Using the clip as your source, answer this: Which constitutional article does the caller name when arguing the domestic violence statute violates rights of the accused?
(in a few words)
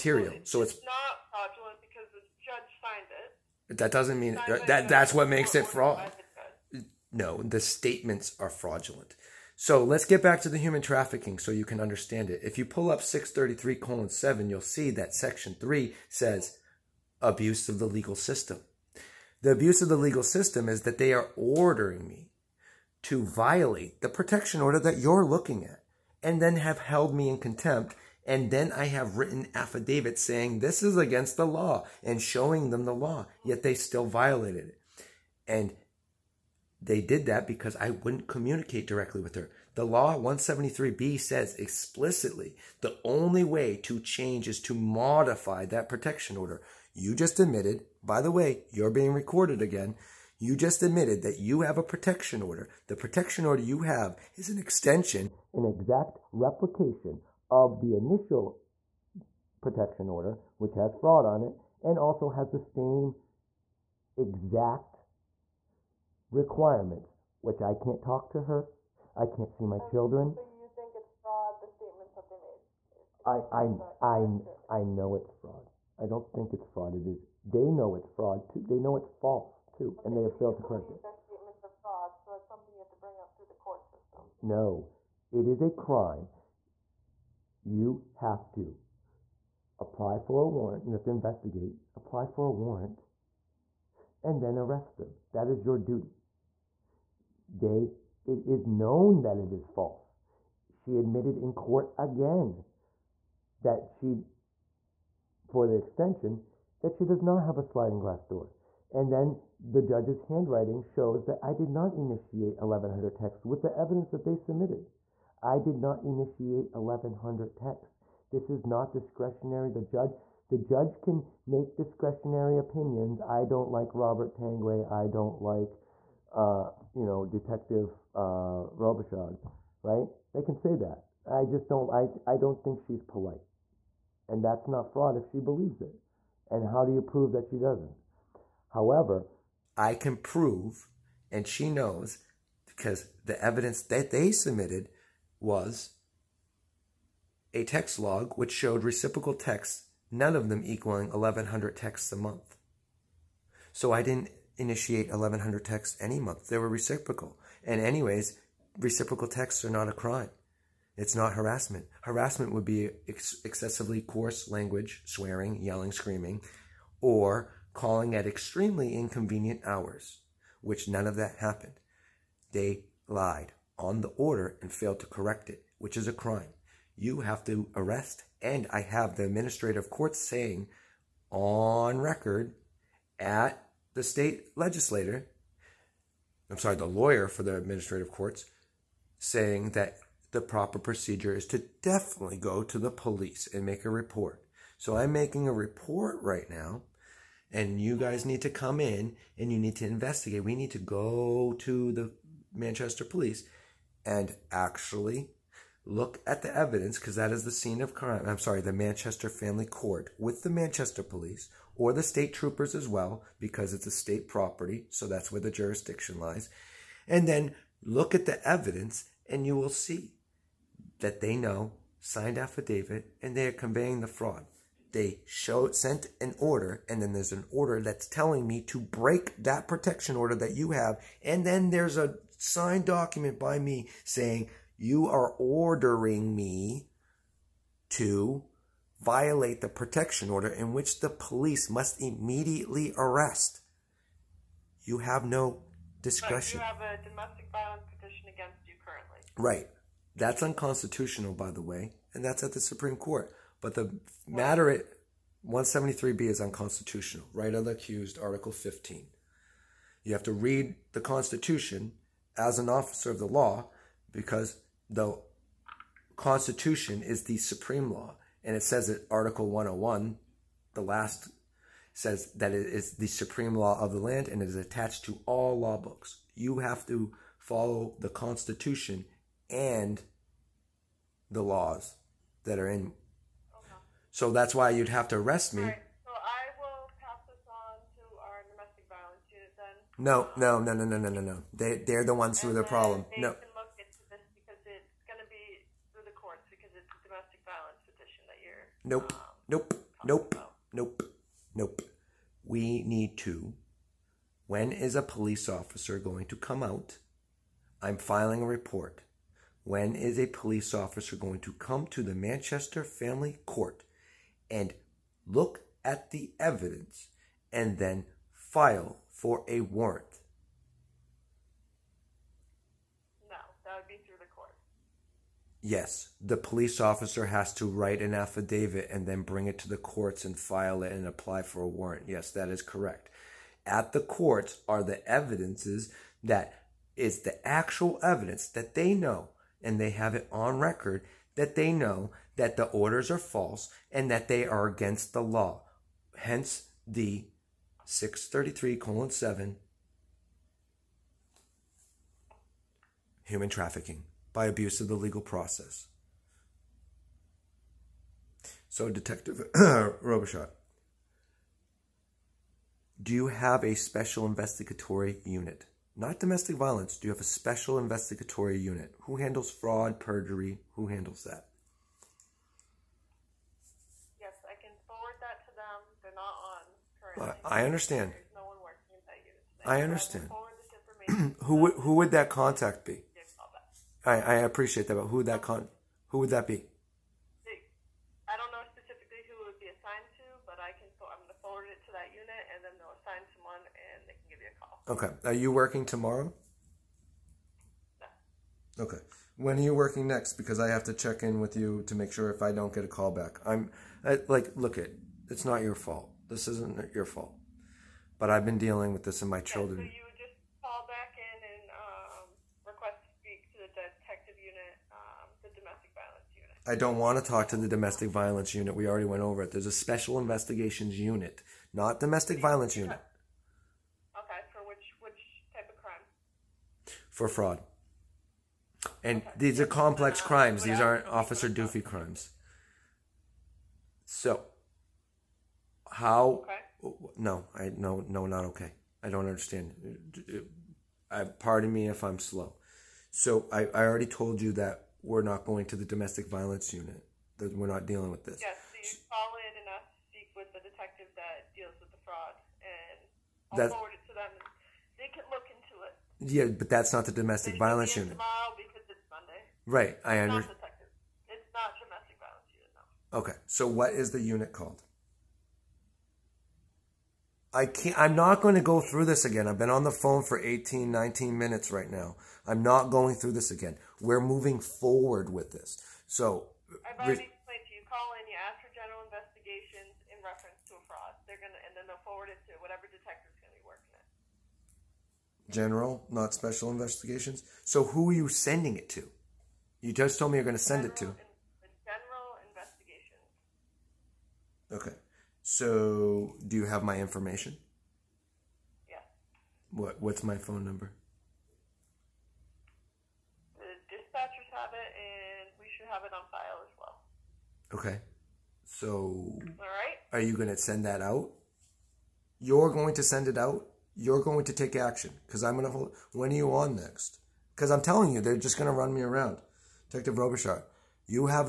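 Article 15.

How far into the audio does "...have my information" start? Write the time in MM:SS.
08:16.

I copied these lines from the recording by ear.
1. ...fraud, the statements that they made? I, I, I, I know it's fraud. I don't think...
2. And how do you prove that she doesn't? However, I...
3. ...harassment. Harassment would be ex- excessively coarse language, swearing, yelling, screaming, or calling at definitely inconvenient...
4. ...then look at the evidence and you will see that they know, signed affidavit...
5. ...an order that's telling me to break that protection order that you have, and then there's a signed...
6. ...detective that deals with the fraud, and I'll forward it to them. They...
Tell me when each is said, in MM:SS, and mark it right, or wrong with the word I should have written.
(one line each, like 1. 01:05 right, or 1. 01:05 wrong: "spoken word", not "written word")
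1. 01:11 right
2. 02:16 right
3. 02:41 wrong: "extremely", not "definitely"
4. 03:37 right
5. 03:47 right
6. 07:30 right.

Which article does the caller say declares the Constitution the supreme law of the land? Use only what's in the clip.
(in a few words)
Article 101.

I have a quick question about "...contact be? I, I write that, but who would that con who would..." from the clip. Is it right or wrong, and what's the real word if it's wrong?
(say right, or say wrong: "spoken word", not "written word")
wrong: "appreciate", not "write".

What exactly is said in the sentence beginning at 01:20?
Their statements are fraud, so that's something you have to bring up through the court system.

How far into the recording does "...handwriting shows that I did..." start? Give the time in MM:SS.
01:50.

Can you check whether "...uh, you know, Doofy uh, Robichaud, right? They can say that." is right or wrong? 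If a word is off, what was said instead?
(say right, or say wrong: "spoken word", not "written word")
wrong: "Detective", not "Doofy".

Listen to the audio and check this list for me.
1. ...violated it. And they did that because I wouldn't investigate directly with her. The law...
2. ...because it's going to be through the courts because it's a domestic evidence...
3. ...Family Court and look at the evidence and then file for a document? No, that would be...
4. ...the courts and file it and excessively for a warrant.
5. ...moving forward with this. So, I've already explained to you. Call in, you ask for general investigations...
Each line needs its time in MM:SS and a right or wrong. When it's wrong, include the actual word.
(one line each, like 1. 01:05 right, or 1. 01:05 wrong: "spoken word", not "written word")
1. 00:34 wrong: "communicate", not "investigate"
2. 04:54 wrong: "violence", not "evidence"
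3. 05:12 wrong: "warrant", not "document"
4. 05:29 wrong: "apply", not "excessively"
5. 07:54 right.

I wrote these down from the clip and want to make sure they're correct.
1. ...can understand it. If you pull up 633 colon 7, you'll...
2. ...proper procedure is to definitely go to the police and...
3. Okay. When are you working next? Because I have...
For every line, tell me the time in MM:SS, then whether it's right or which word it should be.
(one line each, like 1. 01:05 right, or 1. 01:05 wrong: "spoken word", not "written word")
1. 00:11 right
2. 03:10 right
3. 06:38 right.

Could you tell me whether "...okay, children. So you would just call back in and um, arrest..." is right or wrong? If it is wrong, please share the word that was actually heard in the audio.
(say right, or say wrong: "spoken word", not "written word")
wrong: "request", not "arrest".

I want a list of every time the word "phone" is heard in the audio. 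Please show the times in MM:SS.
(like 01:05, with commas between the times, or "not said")
07:49, 08:20.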